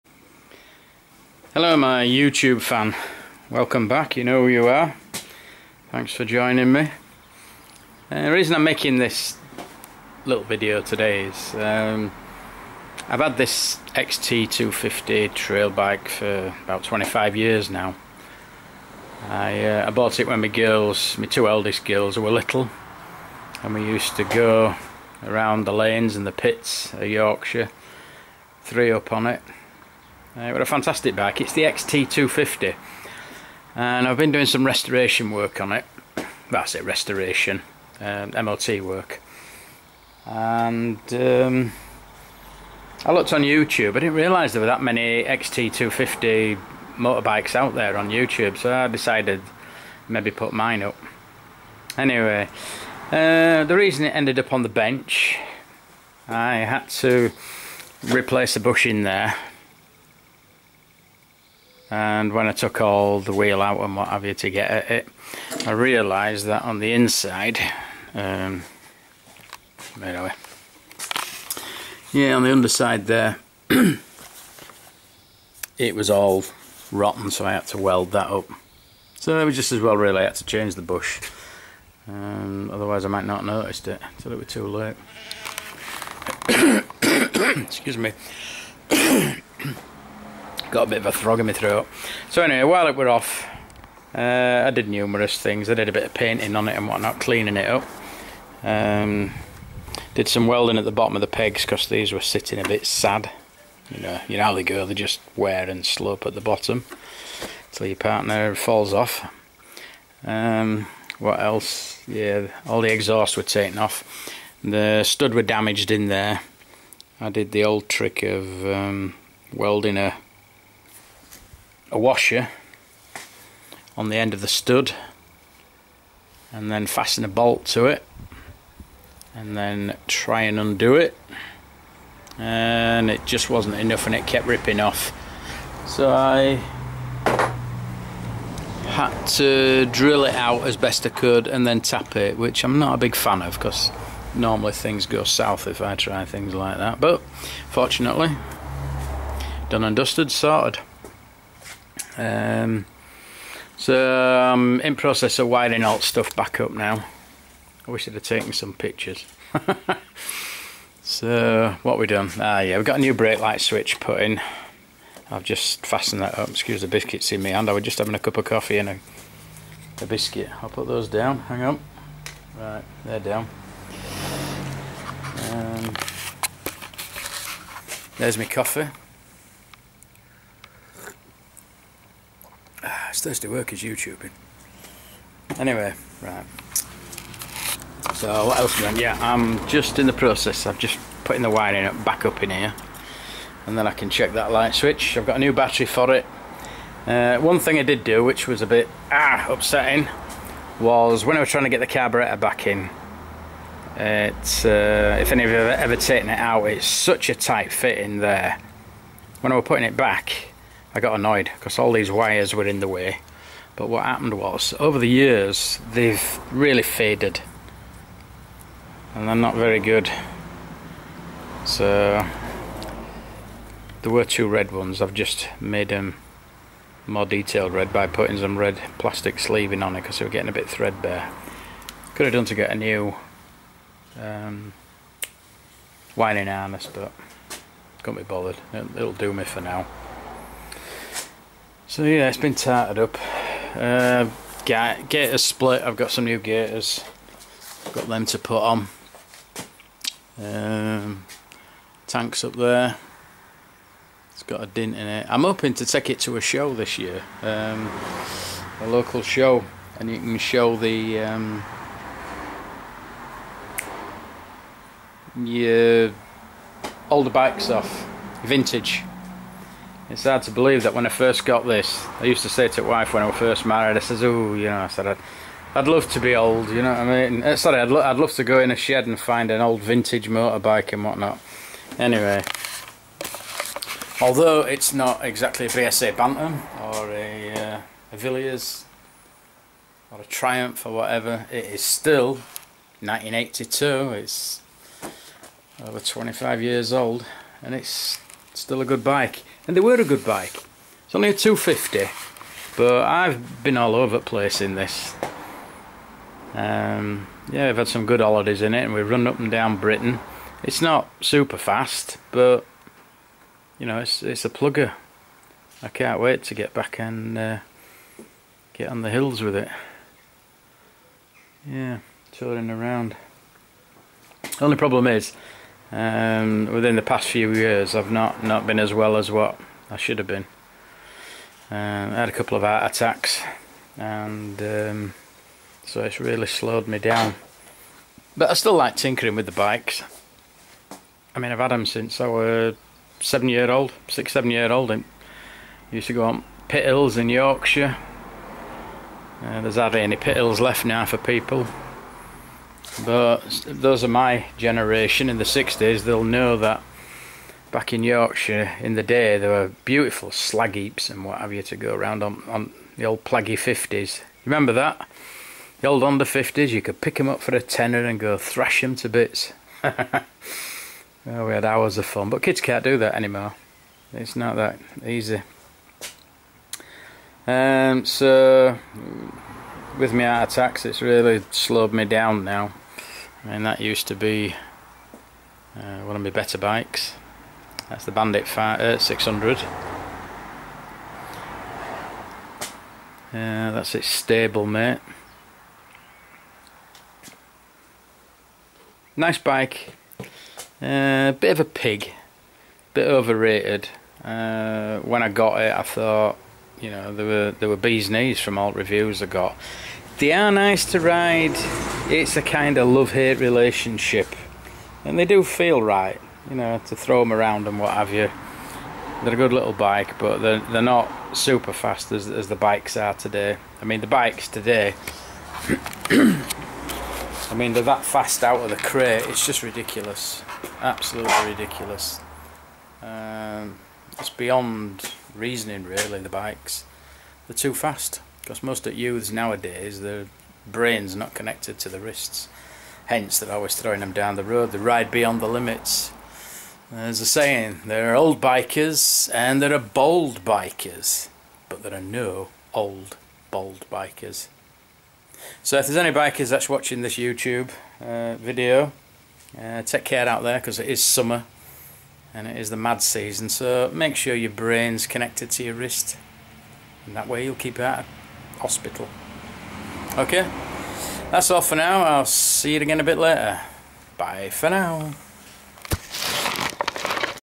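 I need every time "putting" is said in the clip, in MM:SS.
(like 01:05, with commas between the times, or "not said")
03:11, 03:29, 03:48.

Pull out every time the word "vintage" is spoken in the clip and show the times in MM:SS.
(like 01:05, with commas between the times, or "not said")
04:28, 04:39.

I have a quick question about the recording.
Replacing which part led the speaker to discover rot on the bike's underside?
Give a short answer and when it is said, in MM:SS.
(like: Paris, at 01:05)
A bush, at 00:58.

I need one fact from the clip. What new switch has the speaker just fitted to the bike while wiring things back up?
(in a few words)
Brake light switch.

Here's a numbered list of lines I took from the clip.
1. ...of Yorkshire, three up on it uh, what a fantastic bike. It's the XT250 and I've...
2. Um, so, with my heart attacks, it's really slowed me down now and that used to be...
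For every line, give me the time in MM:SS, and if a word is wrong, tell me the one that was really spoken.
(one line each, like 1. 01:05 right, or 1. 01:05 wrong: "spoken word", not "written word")
1. 00:26 right
2. 06:17 right.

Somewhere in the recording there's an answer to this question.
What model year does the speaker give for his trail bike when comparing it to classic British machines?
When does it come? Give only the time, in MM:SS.
04:52.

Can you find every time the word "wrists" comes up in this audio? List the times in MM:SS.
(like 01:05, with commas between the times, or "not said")
07:21, 07:45.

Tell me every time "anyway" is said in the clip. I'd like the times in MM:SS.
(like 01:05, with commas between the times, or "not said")
00:51, 01:32, 03:05, 04:41.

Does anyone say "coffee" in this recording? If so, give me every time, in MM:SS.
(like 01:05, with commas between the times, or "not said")
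02:48, 02:58.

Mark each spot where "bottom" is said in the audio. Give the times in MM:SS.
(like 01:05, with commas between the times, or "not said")
01:40, 01:46.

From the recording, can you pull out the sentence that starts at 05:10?
It's not super fast, but you know, it's it's a plugger.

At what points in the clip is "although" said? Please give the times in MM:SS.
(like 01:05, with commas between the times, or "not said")
04:44.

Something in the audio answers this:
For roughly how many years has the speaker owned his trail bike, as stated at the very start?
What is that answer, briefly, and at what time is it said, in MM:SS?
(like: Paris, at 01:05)
25 years, at 00:16.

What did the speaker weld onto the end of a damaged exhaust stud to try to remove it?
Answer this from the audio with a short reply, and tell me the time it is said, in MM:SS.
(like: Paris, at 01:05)
A washer, at 02:01.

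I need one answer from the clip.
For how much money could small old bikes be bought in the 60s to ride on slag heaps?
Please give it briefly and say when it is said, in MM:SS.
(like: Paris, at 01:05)
A tenner, at 06:07.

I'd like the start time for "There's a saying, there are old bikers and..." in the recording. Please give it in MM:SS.
07:26.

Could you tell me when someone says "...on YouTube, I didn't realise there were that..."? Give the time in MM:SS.
00:43.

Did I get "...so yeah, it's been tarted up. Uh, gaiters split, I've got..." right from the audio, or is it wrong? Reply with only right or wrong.
right.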